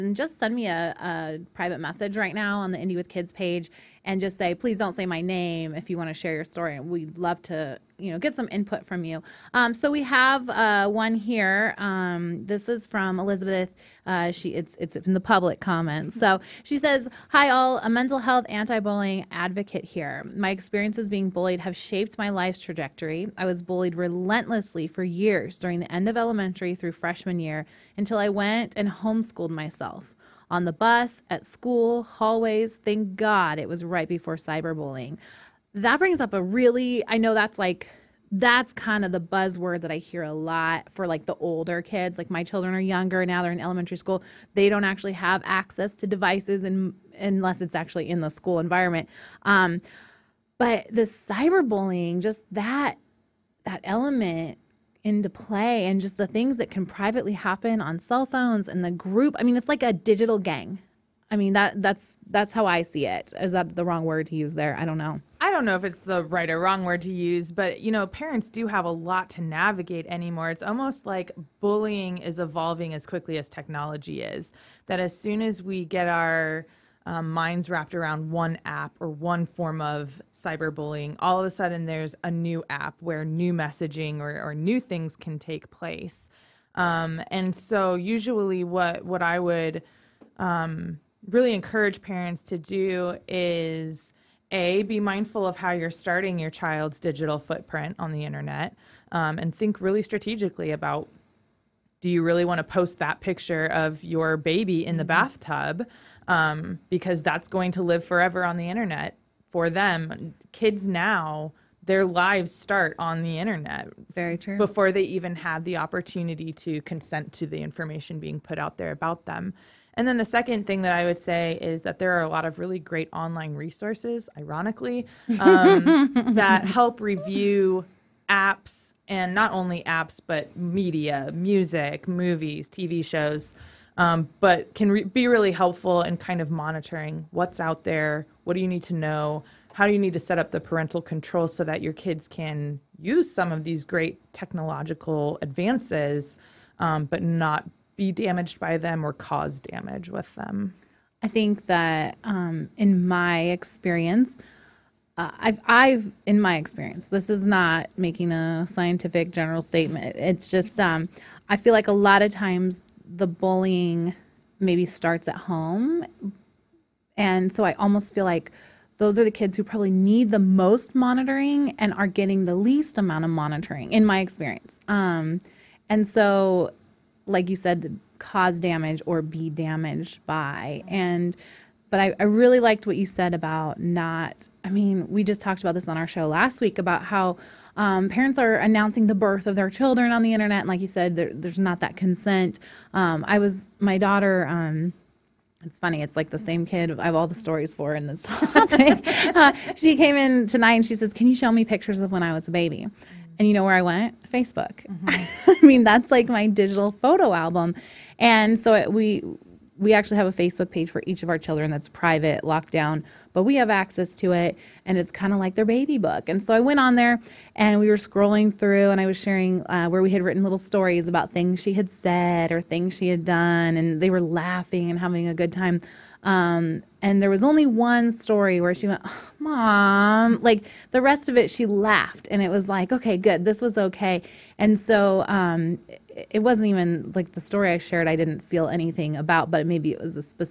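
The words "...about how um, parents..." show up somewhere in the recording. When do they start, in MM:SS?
03:06.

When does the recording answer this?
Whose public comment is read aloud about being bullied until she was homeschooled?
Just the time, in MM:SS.
00:13.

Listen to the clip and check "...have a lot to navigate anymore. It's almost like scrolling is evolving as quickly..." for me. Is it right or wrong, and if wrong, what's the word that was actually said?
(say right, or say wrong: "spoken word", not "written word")
wrong: "bullying", not "scrolling".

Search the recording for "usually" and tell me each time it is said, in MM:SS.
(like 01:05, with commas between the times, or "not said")
01:27.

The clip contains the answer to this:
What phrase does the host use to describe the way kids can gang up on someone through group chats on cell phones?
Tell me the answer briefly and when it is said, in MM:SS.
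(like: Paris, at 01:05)
digital gang, at 00:59.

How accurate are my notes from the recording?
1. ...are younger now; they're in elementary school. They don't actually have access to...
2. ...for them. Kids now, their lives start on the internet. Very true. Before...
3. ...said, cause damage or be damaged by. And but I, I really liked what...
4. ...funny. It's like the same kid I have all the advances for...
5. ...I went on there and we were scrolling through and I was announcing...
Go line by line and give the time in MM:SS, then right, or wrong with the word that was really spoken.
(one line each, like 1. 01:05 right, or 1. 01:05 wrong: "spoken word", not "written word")
1. 00:42 right
2. 01:49 right
3. 02:57 right
4. 03:15 wrong: "stories", not "advances"
5. 03:36 wrong: "sharing", not "announcing".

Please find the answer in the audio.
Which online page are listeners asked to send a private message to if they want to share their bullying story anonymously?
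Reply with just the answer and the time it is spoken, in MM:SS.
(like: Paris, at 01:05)
Indy with Kids, at 00:02.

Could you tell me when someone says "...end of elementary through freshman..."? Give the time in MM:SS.
00:25.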